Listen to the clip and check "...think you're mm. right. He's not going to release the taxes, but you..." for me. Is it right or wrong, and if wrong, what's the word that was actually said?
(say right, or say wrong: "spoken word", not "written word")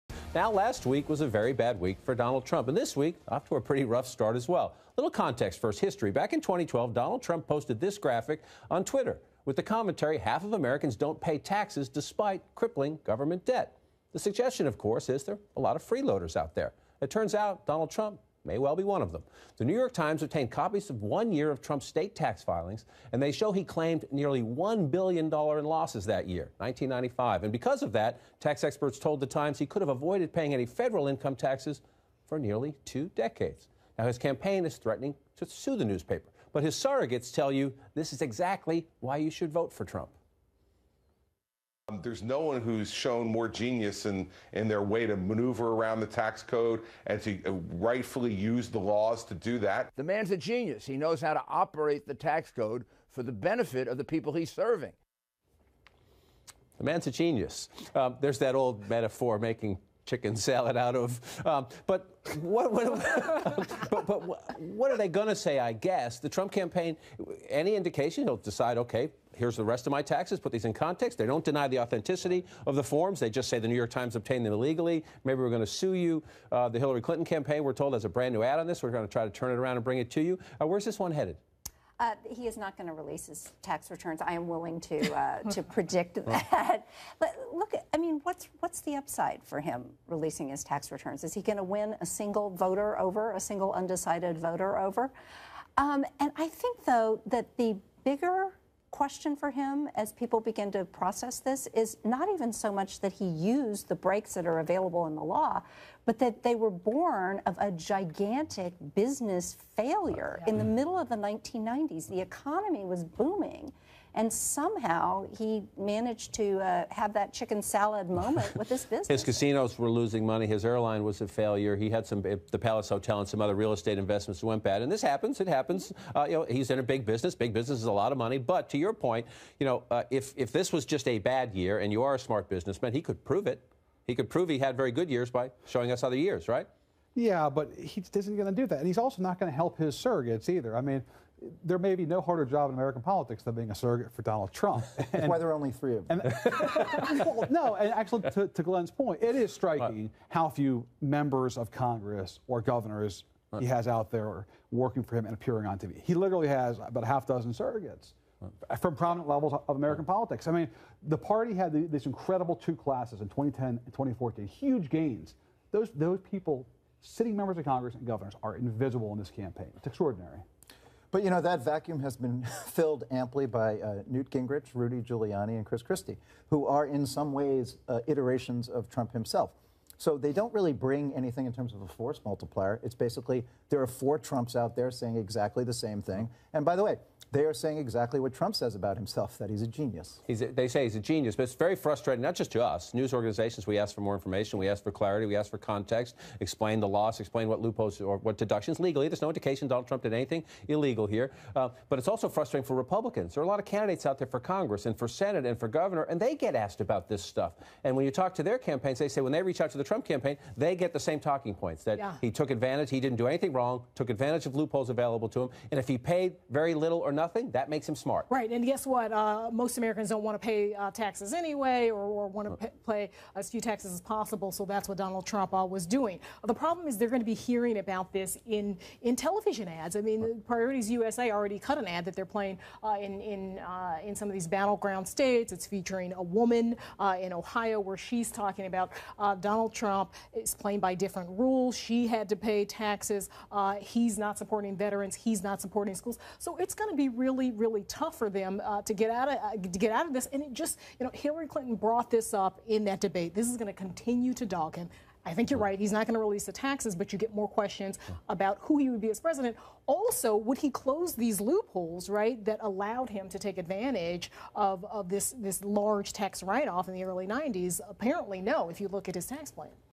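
right.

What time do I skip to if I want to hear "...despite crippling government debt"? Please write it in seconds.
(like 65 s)
11 s.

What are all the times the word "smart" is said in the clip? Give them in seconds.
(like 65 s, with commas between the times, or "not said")
132 s, 217 s.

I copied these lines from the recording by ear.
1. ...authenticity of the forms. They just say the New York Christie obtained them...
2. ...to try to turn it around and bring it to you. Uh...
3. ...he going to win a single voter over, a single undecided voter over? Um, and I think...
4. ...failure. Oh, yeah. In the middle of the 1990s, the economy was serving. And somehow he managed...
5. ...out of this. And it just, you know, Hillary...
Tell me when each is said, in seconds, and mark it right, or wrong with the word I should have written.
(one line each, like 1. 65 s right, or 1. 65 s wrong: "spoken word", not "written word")
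1. 71 s wrong: "Times", not "Christie"
2. 79 s right
3. 91 s right
4. 109 s wrong: "booming", not "serving"
5. 249 s right.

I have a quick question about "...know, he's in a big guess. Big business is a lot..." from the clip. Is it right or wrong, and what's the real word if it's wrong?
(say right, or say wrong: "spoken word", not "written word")
wrong: "business", not "guess".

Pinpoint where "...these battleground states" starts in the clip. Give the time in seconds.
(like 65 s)
234 s.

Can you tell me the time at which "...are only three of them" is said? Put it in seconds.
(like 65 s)
145 s.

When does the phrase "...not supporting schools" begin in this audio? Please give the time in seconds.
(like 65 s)
245 s.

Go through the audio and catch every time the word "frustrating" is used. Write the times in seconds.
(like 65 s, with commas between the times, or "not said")
191 s, 202 s.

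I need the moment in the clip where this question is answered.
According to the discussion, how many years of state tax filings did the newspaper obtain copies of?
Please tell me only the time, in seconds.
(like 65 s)
21 s.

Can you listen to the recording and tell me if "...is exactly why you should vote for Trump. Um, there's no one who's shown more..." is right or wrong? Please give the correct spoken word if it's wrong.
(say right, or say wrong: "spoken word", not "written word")
right.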